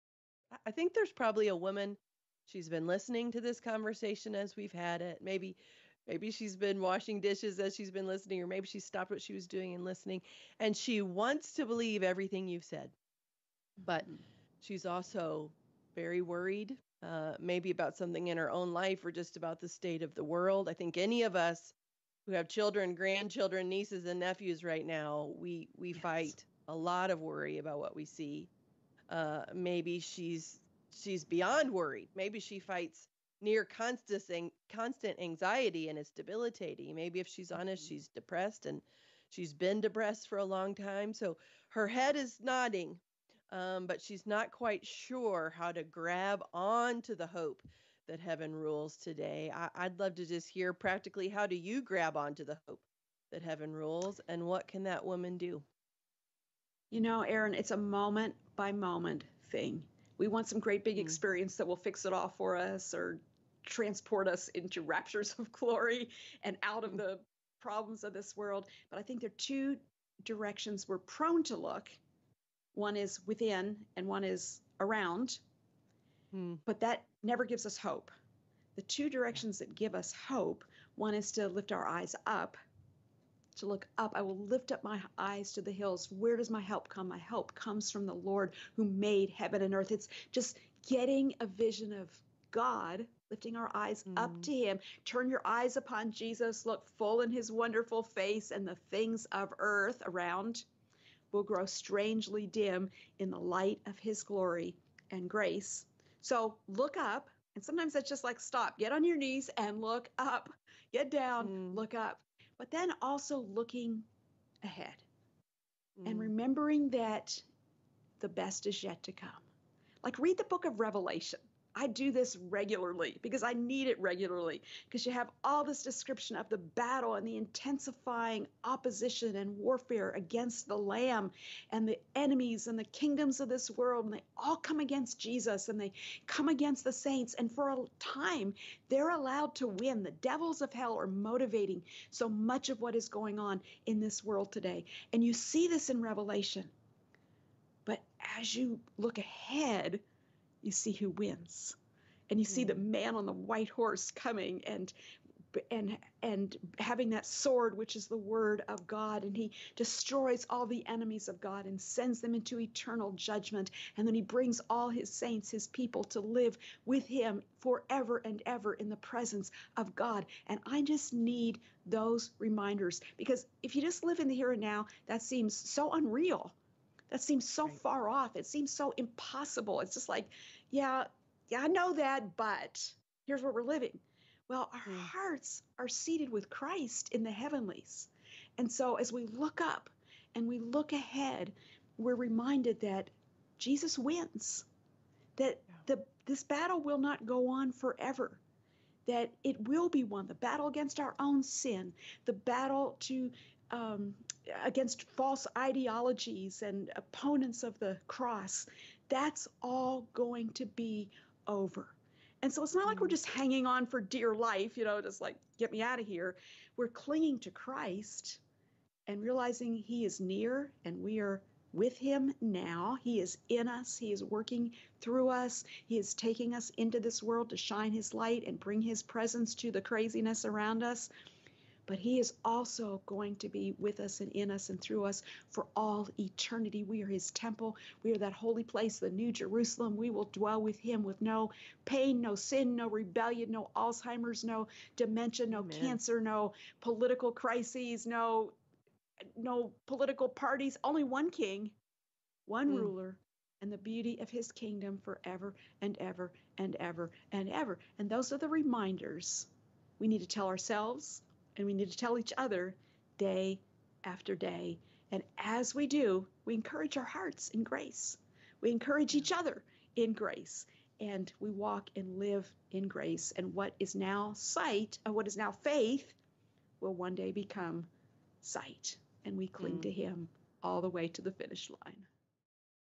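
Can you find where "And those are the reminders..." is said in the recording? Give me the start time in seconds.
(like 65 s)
257 s.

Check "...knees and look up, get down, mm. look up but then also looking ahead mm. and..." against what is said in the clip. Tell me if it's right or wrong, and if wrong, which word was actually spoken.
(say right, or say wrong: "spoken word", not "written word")
right.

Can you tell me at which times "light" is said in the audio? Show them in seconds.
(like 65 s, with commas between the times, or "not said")
103 s, 228 s.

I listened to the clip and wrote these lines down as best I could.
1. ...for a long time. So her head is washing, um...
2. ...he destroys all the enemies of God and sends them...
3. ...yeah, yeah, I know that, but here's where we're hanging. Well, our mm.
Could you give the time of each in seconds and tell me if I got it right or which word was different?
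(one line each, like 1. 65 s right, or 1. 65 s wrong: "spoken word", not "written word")
1. 40 s wrong: "nodding", not "washing"
2. 159 s right
3. 180 s wrong: "living", not "hanging".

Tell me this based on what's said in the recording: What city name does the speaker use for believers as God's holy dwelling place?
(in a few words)
New Jerusalem.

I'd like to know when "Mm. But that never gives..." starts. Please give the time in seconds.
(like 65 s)
76 s.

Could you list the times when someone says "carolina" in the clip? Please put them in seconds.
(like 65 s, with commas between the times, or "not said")
not said.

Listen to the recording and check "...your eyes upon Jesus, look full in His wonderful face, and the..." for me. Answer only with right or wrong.
right.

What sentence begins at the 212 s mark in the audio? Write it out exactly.
And so it's not like we're just hanging on for dear life, you know, just like, get me out of here.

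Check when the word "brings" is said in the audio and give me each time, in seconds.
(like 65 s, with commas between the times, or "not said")
164 s, 228 s.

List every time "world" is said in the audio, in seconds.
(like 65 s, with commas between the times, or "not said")
20 s, 68 s, 133 s, 144 s, 227 s.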